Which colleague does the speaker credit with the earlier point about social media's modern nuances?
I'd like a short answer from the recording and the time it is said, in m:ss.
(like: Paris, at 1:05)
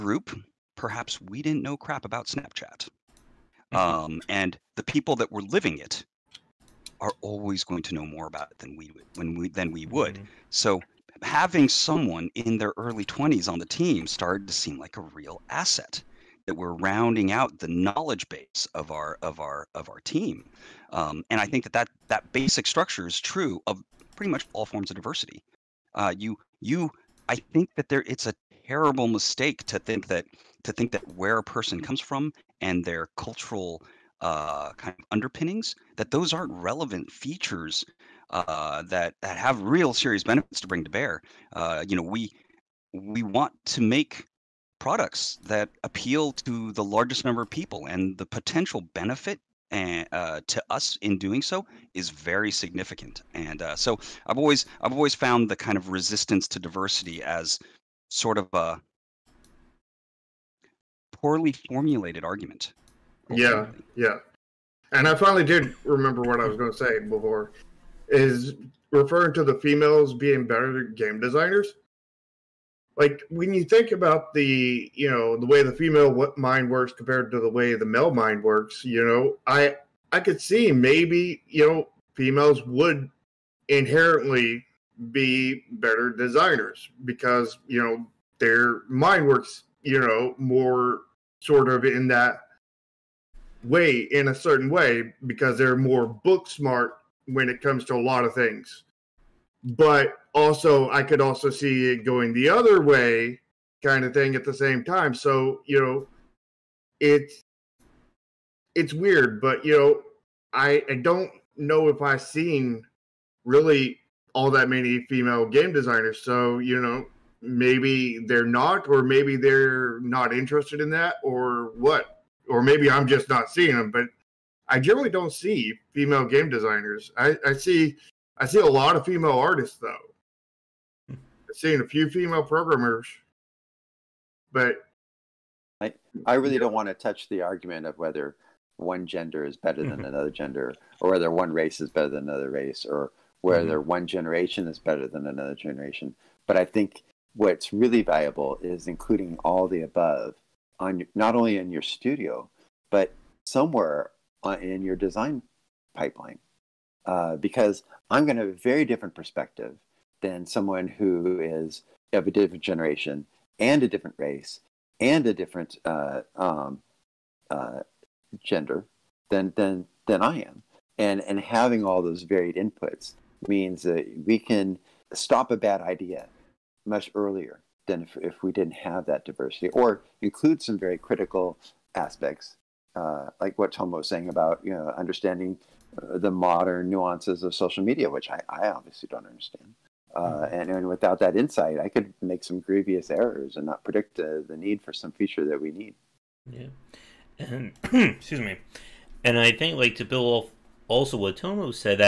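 Tom, at 3:03.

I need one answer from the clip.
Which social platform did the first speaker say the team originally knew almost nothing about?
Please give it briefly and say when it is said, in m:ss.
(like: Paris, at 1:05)
Snapchat, at 0:02.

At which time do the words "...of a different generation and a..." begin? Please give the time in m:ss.
2:42.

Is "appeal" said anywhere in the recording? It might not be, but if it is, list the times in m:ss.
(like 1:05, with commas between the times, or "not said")
0:45.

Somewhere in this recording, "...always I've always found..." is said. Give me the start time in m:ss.
0:54.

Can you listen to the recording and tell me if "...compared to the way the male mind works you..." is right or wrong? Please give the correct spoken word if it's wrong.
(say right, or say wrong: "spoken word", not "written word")
right.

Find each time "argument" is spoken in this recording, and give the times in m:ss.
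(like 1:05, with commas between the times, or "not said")
1:02, 2:17.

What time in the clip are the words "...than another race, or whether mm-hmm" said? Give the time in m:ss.
2:22.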